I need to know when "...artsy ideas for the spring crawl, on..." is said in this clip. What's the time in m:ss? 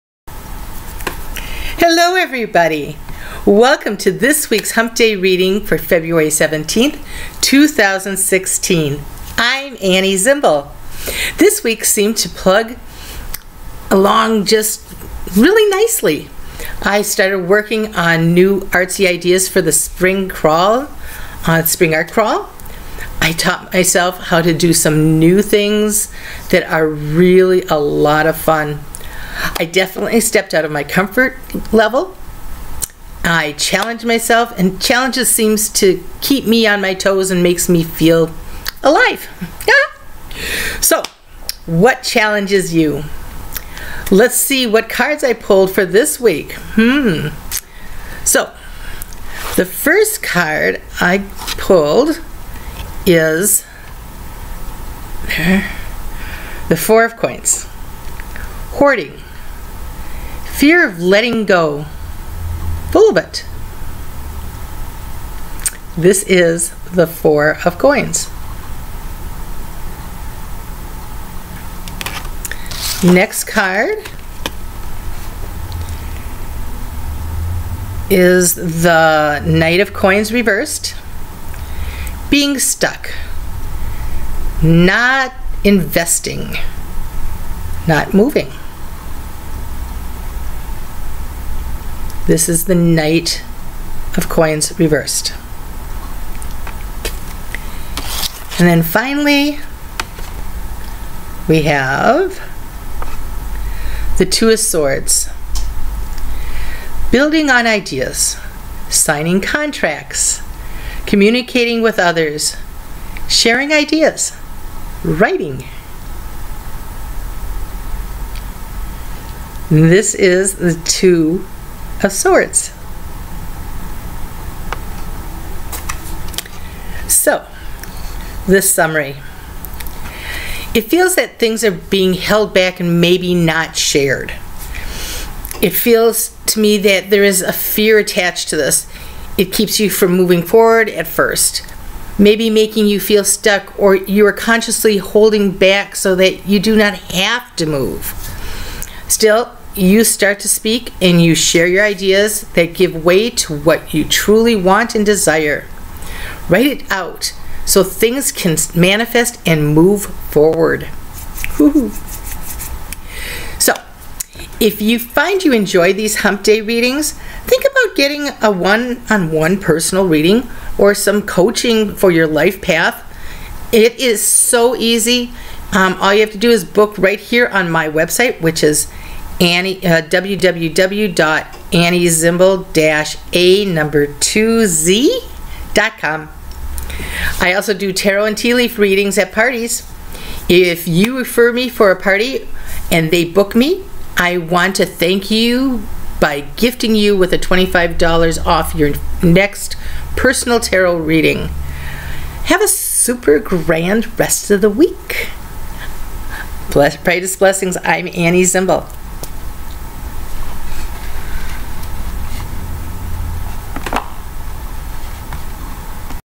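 0:18.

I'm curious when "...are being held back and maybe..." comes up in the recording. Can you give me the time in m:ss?
2:11.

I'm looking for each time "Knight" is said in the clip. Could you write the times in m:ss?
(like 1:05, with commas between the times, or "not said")
1:19, 1:32.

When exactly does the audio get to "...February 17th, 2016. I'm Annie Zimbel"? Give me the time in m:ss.
0:05.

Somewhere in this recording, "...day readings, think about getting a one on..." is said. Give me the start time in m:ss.
2:46.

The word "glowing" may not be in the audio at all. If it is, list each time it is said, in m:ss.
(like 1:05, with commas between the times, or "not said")
not said.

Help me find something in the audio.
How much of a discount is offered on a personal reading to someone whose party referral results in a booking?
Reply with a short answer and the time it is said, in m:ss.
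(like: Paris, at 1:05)
$25, at 3:17.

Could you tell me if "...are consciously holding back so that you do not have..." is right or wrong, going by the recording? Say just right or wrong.
right.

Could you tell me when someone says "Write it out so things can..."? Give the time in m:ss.
2:36.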